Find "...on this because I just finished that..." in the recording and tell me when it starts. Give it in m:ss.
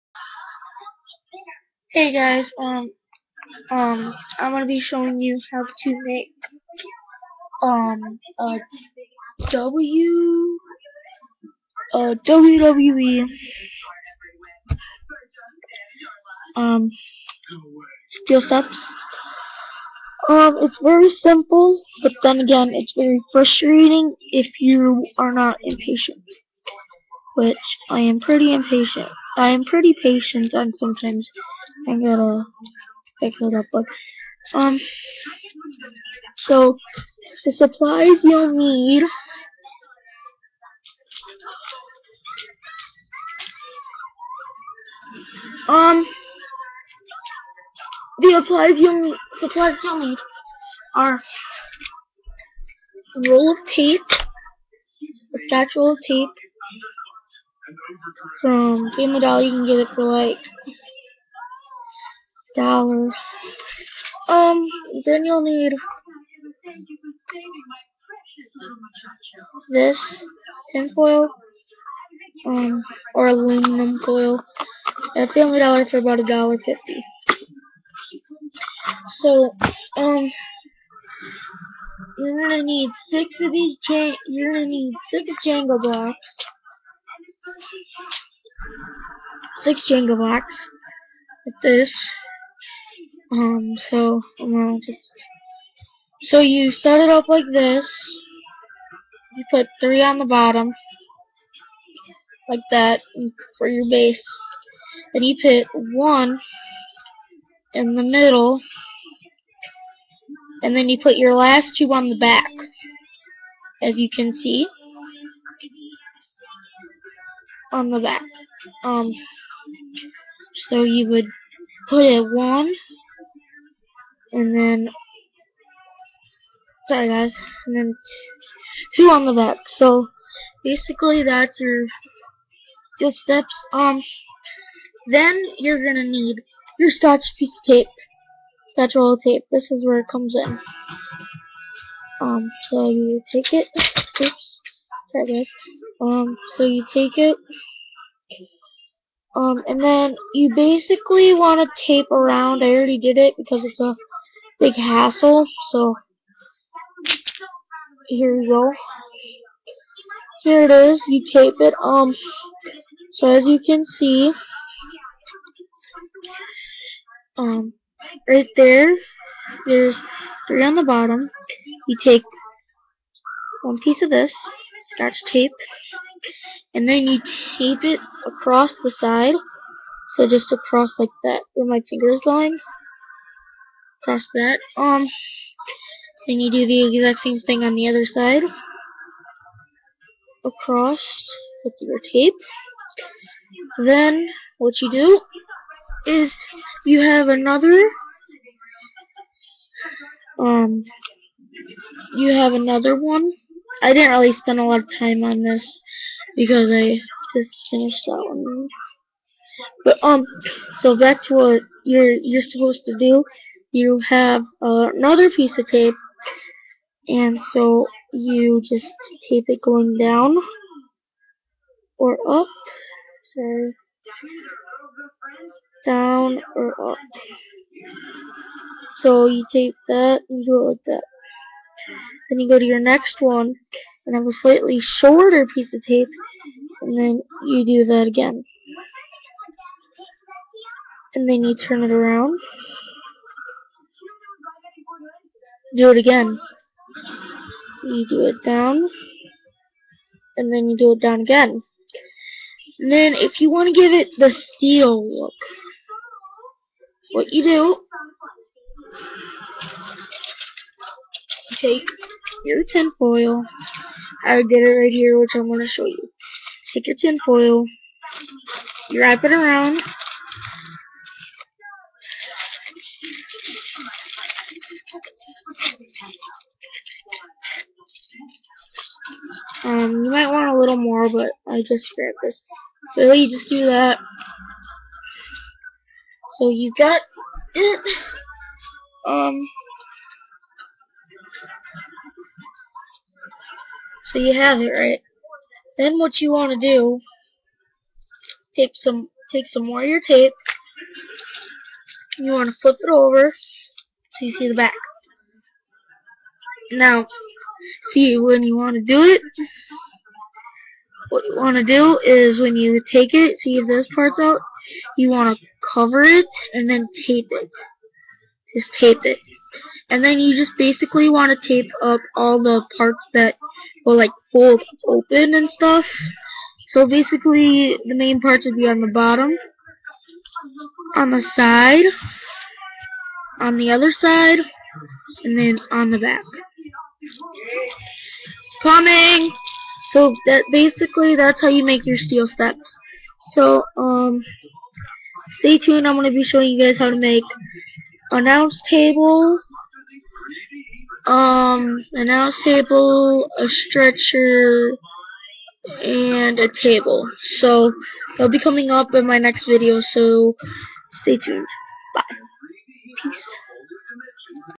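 3:25.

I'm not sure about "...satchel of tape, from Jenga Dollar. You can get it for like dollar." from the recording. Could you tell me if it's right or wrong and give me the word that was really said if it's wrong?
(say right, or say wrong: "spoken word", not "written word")
wrong: "Game", not "Jenga".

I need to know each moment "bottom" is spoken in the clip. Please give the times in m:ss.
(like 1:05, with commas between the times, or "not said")
1:40, 2:50, 5:28.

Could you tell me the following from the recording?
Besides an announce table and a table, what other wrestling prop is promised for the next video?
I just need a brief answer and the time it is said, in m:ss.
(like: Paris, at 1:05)
a stretcher, at 5:53.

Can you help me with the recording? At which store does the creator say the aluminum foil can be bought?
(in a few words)
Family Dollar.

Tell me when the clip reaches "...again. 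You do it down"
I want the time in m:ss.
4:05.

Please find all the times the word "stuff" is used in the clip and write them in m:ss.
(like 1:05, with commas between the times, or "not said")
5:25.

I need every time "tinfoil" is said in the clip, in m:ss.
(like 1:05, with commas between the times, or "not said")
1:10, 4:22, 4:26.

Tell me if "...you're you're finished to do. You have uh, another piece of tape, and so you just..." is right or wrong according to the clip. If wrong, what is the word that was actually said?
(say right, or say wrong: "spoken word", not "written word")
wrong: "supposed", not "finished".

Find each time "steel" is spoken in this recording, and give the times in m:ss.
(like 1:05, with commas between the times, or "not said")
0:18, 2:12, 4:14, 5:41.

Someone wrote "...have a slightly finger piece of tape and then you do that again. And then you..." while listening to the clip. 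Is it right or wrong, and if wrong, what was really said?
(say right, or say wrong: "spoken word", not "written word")
wrong: "shorter", not "finger".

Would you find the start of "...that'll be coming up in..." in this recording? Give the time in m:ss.
5:58.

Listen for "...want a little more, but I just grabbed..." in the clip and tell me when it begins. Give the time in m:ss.
4:40.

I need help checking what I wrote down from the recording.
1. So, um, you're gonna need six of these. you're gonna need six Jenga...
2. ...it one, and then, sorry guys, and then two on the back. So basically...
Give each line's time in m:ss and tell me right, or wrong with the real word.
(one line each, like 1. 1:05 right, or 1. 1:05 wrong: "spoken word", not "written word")
1. 1:19 right
2. 2:02 right.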